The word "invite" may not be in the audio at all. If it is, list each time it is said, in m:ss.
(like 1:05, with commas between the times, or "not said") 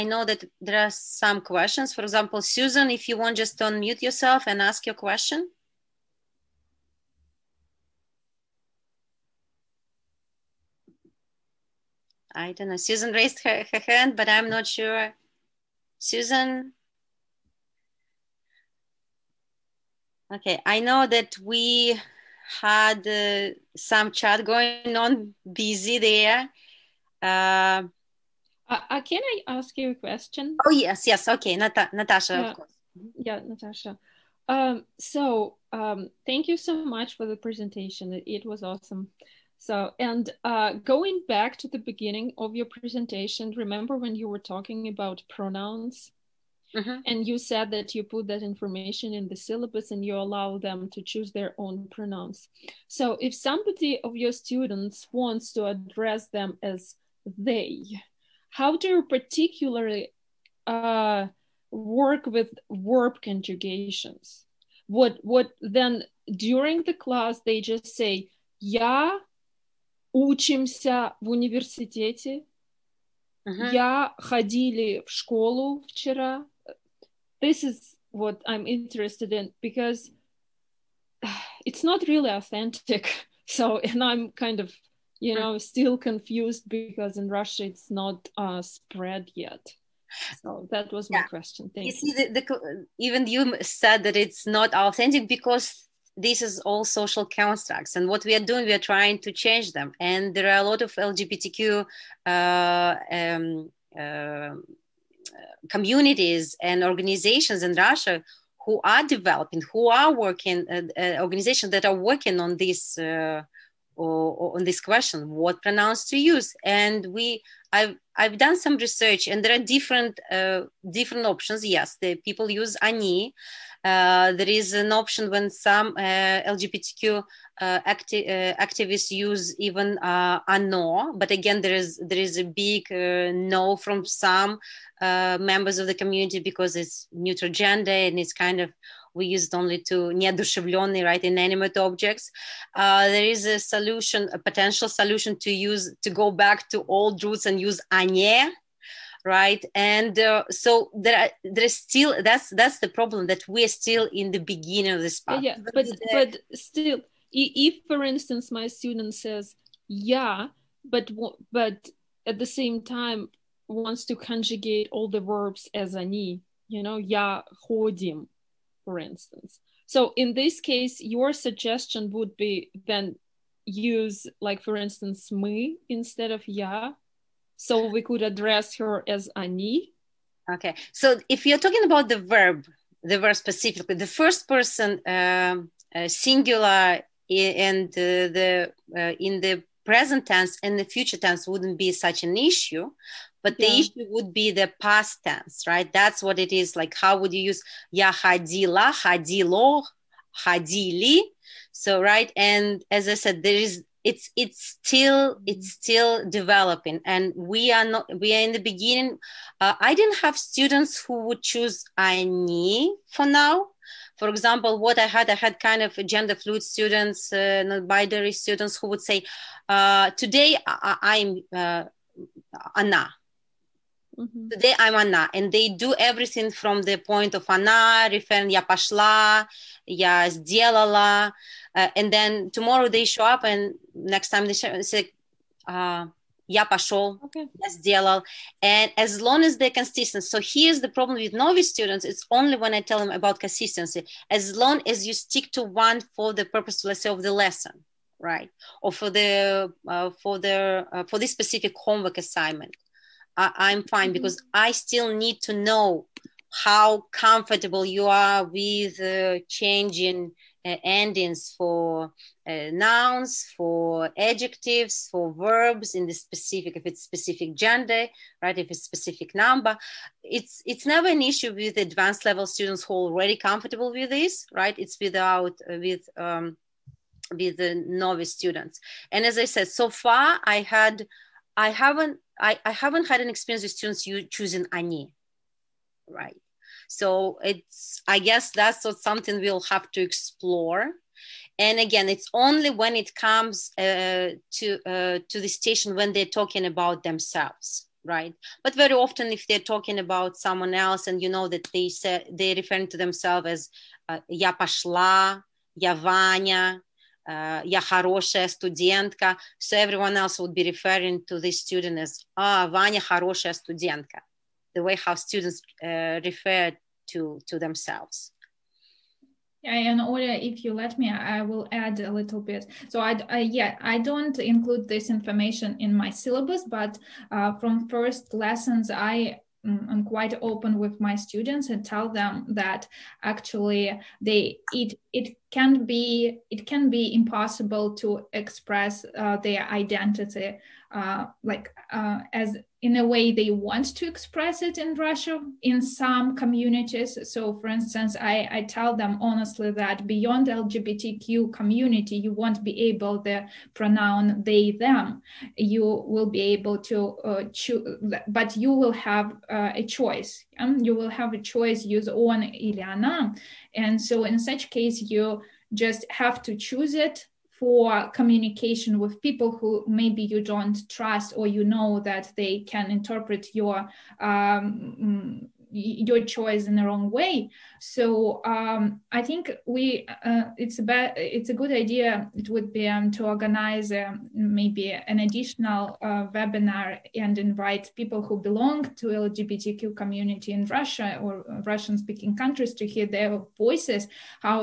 6:27.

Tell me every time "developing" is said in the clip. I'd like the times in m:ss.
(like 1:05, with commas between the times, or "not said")
1:49, 3:26.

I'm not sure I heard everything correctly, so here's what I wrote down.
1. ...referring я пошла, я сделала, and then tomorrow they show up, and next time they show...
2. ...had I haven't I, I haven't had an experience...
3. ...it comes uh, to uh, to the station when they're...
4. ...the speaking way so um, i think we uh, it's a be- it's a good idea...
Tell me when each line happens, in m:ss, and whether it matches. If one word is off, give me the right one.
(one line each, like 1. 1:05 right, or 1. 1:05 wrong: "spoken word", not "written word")
1. 3:48 right
2. 4:40 right
3. 4:52 right
4. 6:16 wrong: "wrong", not "speaking".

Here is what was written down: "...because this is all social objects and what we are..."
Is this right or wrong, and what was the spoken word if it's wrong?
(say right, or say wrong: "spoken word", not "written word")
wrong: "constructs", not "objects".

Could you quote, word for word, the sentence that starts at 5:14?
The way how students uh, refer to, to themselves.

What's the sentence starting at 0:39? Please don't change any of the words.
So, and uh, going back to the beginning of your presentation, remember when you were talking about pronouns?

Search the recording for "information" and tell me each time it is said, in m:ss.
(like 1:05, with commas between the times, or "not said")
0:48, 5:25.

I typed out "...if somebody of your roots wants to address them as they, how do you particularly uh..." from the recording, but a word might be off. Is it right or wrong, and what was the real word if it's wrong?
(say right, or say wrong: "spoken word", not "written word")
wrong: "students", not "roots".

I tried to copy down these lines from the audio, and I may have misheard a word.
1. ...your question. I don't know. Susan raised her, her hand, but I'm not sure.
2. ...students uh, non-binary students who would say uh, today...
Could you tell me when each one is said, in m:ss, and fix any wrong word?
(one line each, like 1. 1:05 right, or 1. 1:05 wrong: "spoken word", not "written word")
1. 0:04 right
2. 3:36 right.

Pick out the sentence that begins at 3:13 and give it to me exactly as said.
the issue would be the past tense, right?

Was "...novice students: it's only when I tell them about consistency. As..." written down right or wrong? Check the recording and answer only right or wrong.
right.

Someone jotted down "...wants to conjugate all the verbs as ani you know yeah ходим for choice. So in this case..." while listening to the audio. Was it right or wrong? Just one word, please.
wrong.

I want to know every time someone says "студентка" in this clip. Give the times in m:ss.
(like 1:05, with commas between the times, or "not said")
5:08, 5:13.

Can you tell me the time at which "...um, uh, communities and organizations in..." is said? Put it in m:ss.
1:43.